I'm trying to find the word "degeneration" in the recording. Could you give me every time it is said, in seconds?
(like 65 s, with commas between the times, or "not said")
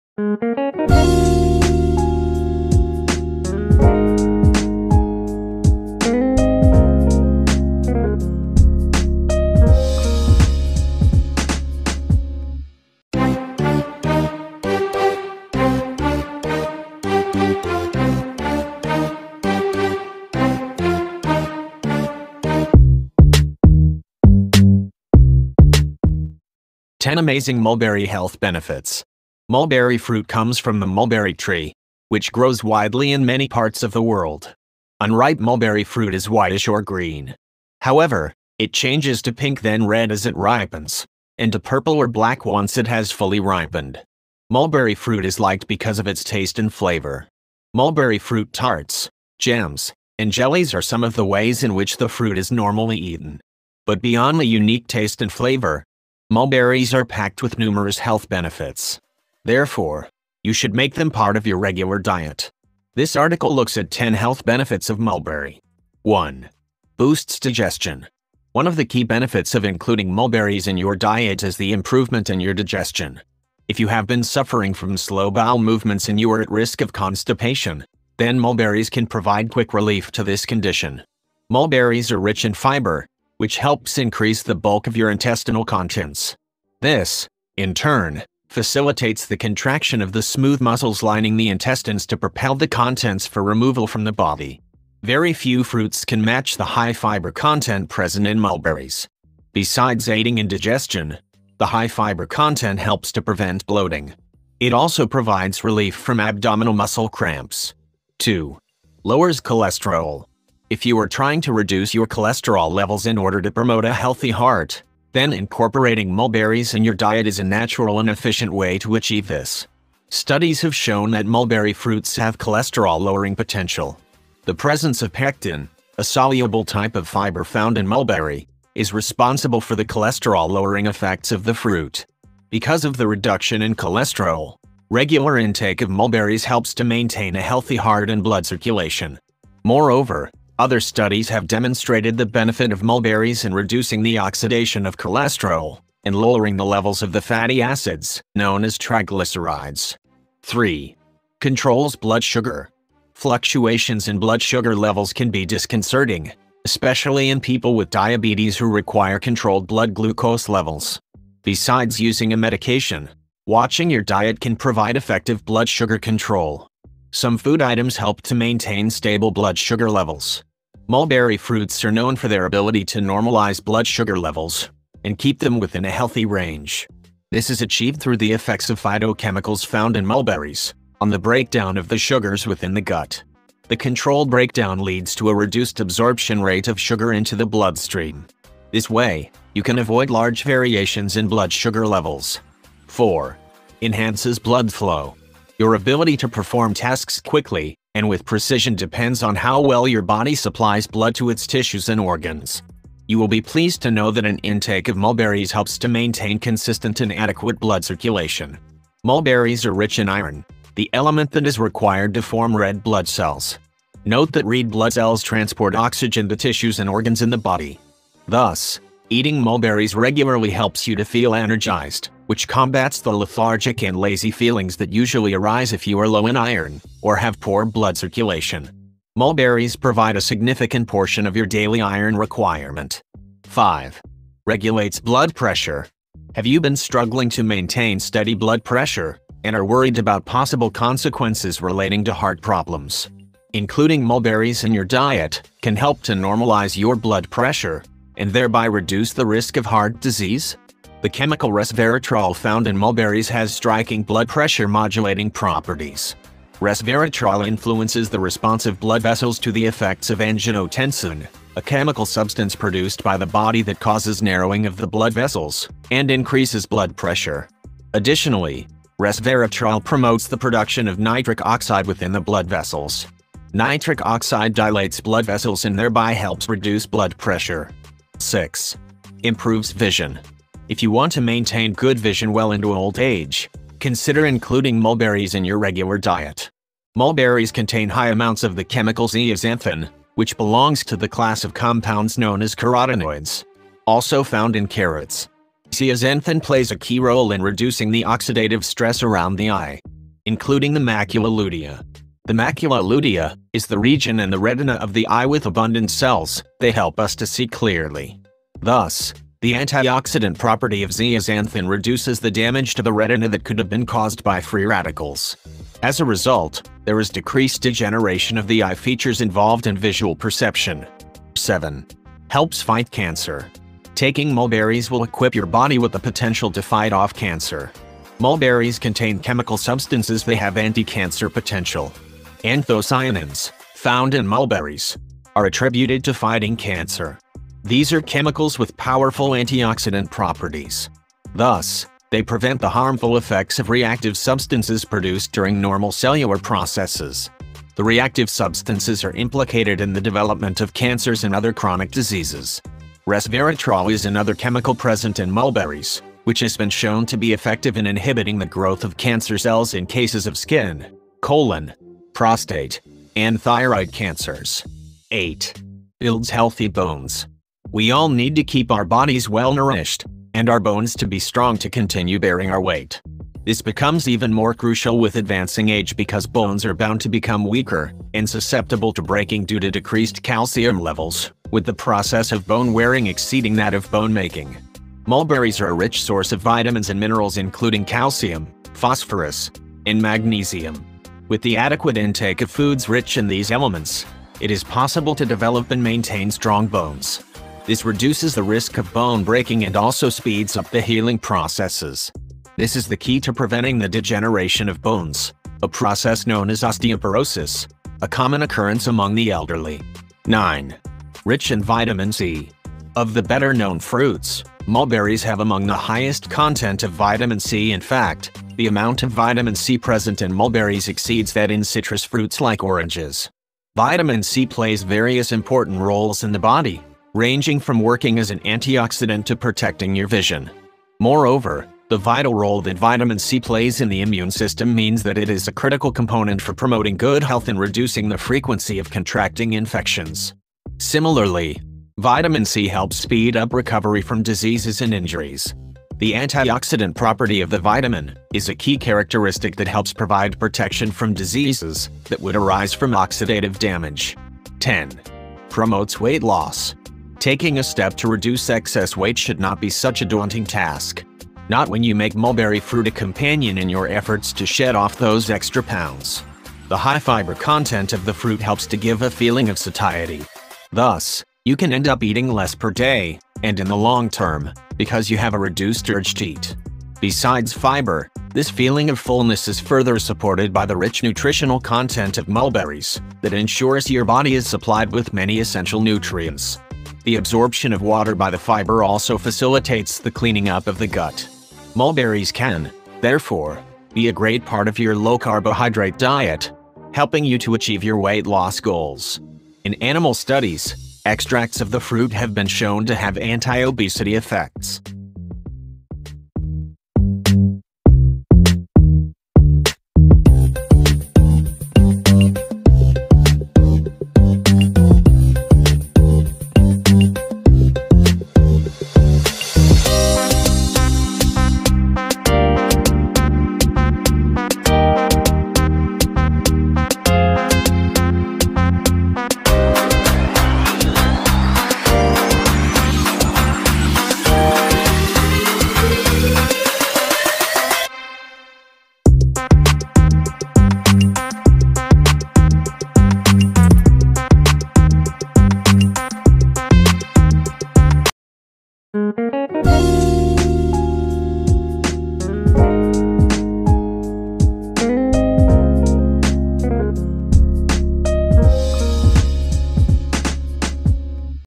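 317 s, 403 s.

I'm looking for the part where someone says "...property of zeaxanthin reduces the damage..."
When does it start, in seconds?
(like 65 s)
310 s.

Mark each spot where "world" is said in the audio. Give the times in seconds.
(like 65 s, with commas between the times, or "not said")
34 s.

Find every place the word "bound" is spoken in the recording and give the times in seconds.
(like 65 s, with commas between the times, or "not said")
376 s.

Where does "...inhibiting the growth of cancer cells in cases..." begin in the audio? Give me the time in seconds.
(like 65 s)
357 s.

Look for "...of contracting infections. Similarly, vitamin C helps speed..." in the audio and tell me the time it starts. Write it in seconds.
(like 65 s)
438 s.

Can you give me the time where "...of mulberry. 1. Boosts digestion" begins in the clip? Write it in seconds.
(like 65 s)
64 s.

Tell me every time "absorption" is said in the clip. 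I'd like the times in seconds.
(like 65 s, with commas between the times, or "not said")
185 s, 487 s.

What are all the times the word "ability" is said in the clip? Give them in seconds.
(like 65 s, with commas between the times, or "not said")
172 s, 195 s.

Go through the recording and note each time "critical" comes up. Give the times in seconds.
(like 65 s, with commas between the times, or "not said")
435 s.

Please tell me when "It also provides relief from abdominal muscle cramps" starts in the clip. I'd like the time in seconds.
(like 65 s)
104 s.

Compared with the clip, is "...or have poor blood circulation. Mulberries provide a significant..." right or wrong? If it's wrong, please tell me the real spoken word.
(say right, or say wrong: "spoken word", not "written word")
right.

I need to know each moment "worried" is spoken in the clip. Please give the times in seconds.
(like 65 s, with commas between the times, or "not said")
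239 s.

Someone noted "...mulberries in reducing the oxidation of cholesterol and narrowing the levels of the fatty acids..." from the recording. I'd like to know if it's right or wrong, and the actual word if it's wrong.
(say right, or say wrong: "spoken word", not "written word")
wrong: "lowering", not "narrowing".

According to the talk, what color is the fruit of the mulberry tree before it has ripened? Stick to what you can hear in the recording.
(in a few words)
Whitish or green.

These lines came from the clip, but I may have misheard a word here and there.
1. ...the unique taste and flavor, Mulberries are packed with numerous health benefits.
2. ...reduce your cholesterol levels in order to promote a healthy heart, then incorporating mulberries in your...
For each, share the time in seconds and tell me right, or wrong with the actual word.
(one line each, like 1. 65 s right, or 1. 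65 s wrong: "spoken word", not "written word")
1. 54 s right
2. 111 s right.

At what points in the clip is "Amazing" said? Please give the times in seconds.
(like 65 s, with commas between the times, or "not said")
27 s.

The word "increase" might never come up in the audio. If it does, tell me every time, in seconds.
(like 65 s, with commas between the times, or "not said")
83 s, 266 s.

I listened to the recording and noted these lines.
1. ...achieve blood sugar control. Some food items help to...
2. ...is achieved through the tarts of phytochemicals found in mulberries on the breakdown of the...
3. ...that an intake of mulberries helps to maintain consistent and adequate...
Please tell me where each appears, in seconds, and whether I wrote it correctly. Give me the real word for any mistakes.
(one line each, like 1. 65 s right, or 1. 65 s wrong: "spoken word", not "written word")
1. 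164 s wrong: "effective", not "achieve"
2. 177 s wrong: "effects", not "tarts"
3. 204 s right.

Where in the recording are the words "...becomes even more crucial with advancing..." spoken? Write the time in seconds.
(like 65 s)
373 s.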